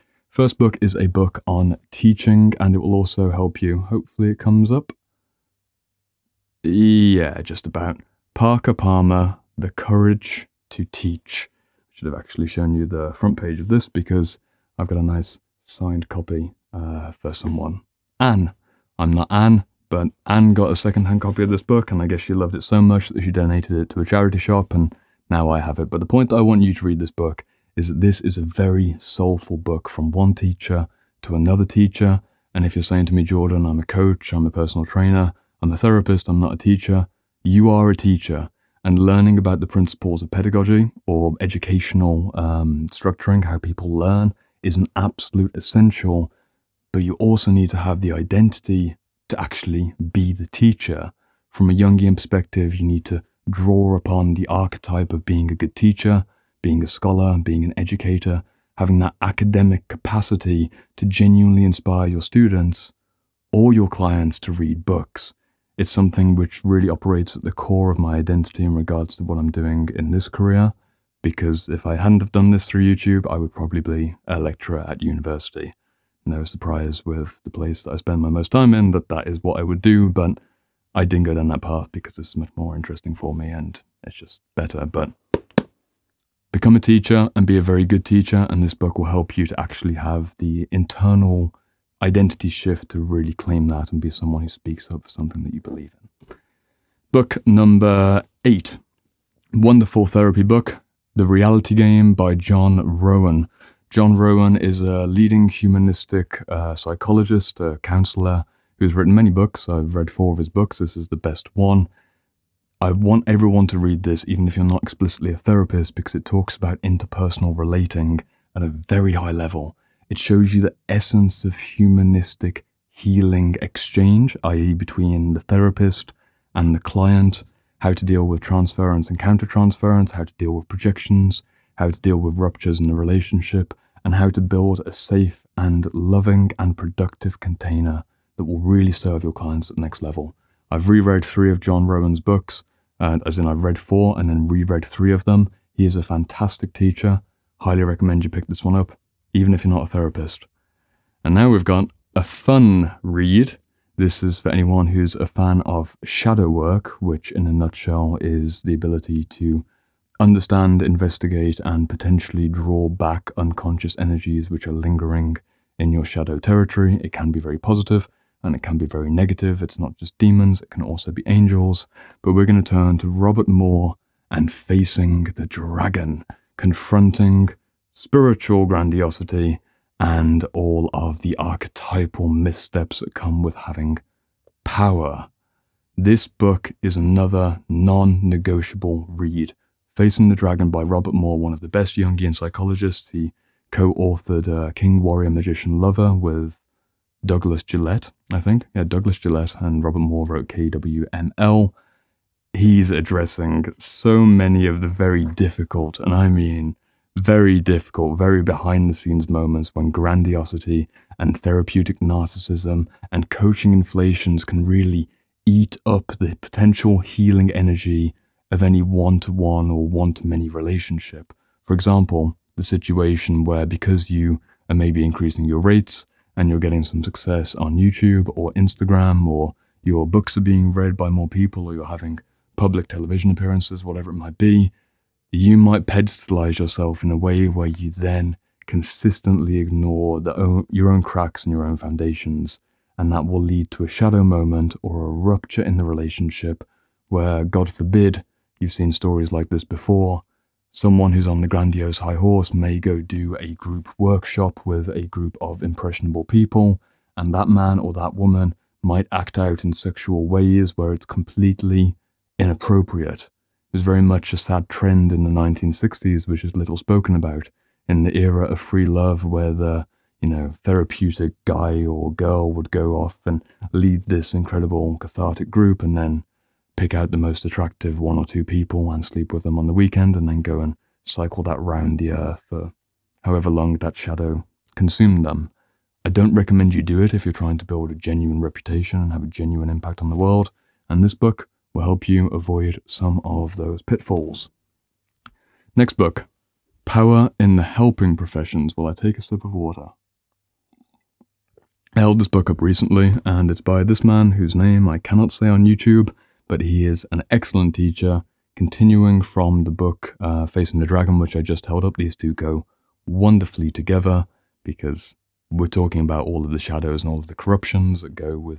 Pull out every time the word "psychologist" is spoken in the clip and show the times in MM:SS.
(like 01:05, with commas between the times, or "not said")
01:46, 03:12.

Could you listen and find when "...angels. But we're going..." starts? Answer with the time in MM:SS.
02:51.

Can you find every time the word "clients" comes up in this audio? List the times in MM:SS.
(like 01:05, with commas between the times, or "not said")
01:03, 02:06, 02:19.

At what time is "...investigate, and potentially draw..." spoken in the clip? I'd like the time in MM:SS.
02:40.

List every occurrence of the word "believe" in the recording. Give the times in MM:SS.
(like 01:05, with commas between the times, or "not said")
01:35.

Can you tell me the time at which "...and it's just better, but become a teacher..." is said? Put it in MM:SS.
01:23.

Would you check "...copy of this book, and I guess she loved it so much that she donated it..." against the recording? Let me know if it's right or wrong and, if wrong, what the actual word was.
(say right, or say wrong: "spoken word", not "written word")
right.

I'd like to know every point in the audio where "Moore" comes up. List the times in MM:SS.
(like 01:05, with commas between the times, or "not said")
02:53, 03:11, 03:19.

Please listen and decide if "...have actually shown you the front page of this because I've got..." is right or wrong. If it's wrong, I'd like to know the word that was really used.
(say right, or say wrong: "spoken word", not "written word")
right.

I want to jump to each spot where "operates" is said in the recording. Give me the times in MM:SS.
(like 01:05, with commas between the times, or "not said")
01:06.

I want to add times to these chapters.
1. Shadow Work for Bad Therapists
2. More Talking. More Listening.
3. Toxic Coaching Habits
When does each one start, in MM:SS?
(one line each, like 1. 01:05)
1. 02:31
2. 01:36
3. 04:54.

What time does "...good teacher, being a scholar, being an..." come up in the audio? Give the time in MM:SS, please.
00:55.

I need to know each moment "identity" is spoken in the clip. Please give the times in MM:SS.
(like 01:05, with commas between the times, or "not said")
00:48, 01:08, 01:32.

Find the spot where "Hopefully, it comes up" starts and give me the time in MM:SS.
00:03.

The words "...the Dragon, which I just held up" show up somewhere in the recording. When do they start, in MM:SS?
05:10.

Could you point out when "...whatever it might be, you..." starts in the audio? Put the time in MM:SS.
03:53.